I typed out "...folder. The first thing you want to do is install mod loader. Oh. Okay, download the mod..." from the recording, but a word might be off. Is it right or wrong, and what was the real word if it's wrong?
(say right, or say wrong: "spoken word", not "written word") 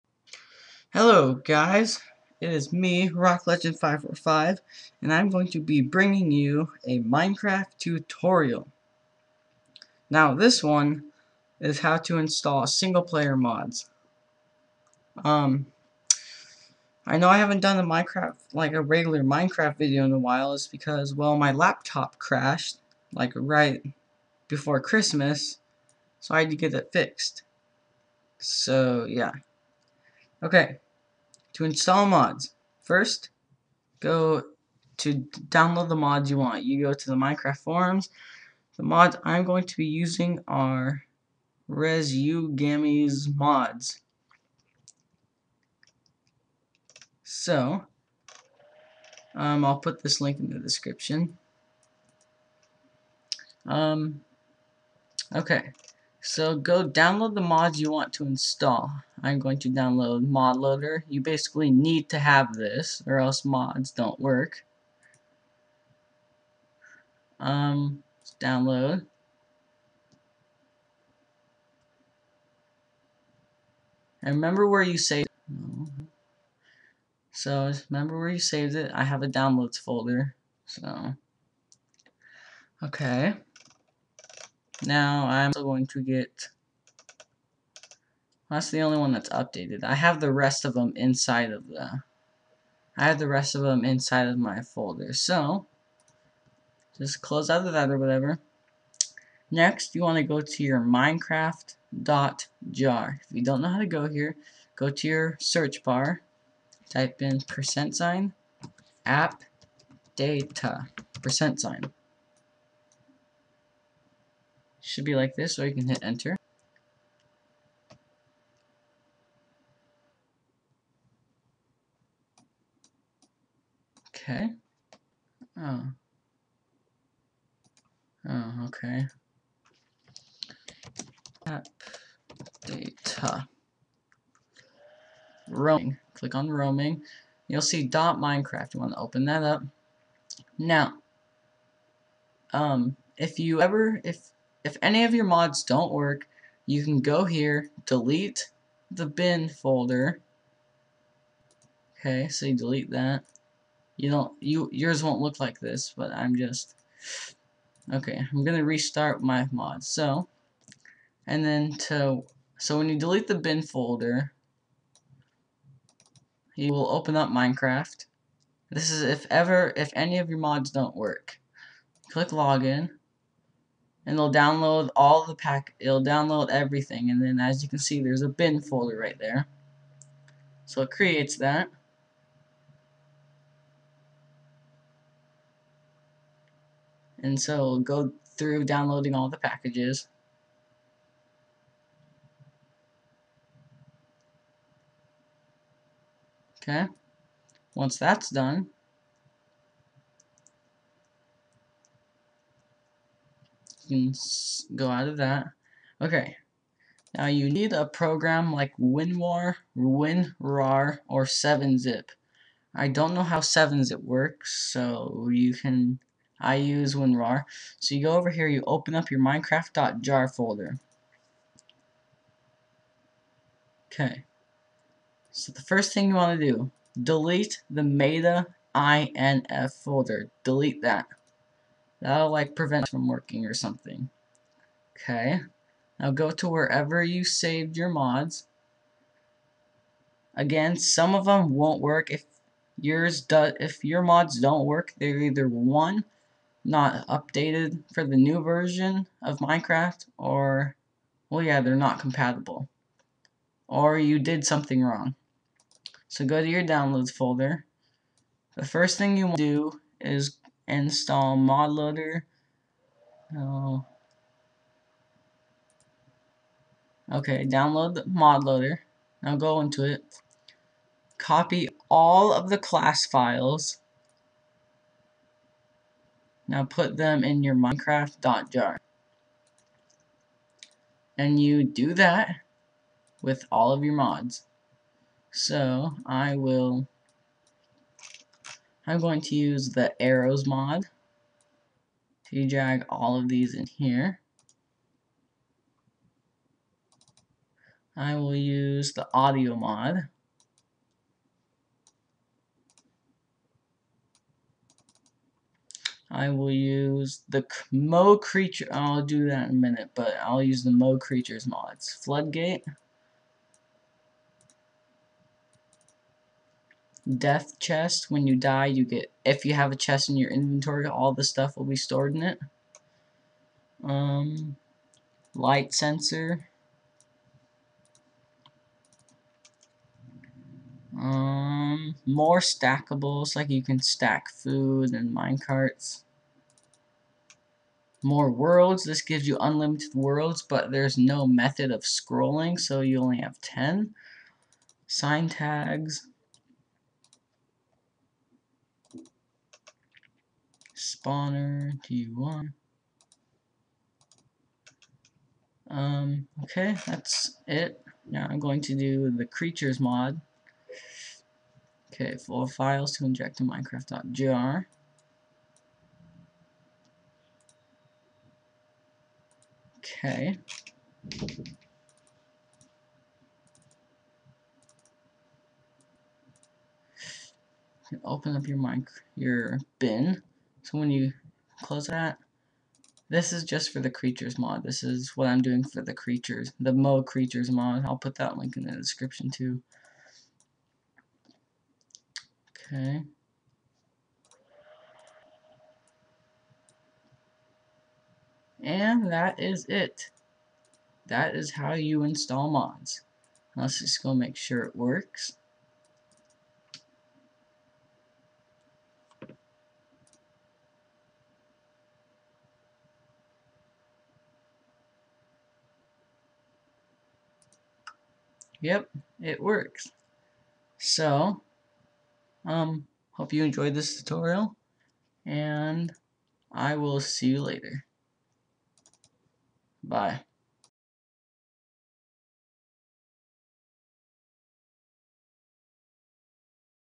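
right.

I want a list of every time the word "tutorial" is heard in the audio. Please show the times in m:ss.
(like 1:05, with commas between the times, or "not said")
0:07, 7:03.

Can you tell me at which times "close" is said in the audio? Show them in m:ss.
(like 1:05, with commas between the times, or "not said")
1:37, 6:21.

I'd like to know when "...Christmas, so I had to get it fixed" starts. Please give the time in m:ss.
0:24.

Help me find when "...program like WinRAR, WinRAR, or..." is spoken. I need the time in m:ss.
3:27.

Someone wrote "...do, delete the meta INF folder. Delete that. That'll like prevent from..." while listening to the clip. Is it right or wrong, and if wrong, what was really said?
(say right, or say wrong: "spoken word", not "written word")
right.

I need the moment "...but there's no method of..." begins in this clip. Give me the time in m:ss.
5:40.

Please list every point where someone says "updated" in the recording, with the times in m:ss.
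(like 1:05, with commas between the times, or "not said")
1:29, 4:07.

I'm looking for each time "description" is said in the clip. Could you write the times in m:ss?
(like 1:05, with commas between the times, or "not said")
0:50, 6:28.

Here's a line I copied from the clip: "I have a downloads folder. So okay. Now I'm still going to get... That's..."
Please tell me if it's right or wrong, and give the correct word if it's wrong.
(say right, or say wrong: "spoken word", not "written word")
right.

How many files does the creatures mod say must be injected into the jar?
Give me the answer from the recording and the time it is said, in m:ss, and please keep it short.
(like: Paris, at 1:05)
4, at 6:02.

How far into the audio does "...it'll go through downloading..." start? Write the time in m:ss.
3:07.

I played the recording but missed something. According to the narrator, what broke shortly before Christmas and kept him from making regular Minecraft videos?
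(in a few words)
laptop.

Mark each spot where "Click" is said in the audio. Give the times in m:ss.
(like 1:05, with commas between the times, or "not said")
2:16, 2:52.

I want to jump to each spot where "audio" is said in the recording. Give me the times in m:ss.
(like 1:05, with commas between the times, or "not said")
4:59.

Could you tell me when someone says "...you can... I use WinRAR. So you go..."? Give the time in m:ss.
3:35.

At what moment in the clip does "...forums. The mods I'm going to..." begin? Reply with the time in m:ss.
0:37.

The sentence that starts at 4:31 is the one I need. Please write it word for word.
Copy all of the class files.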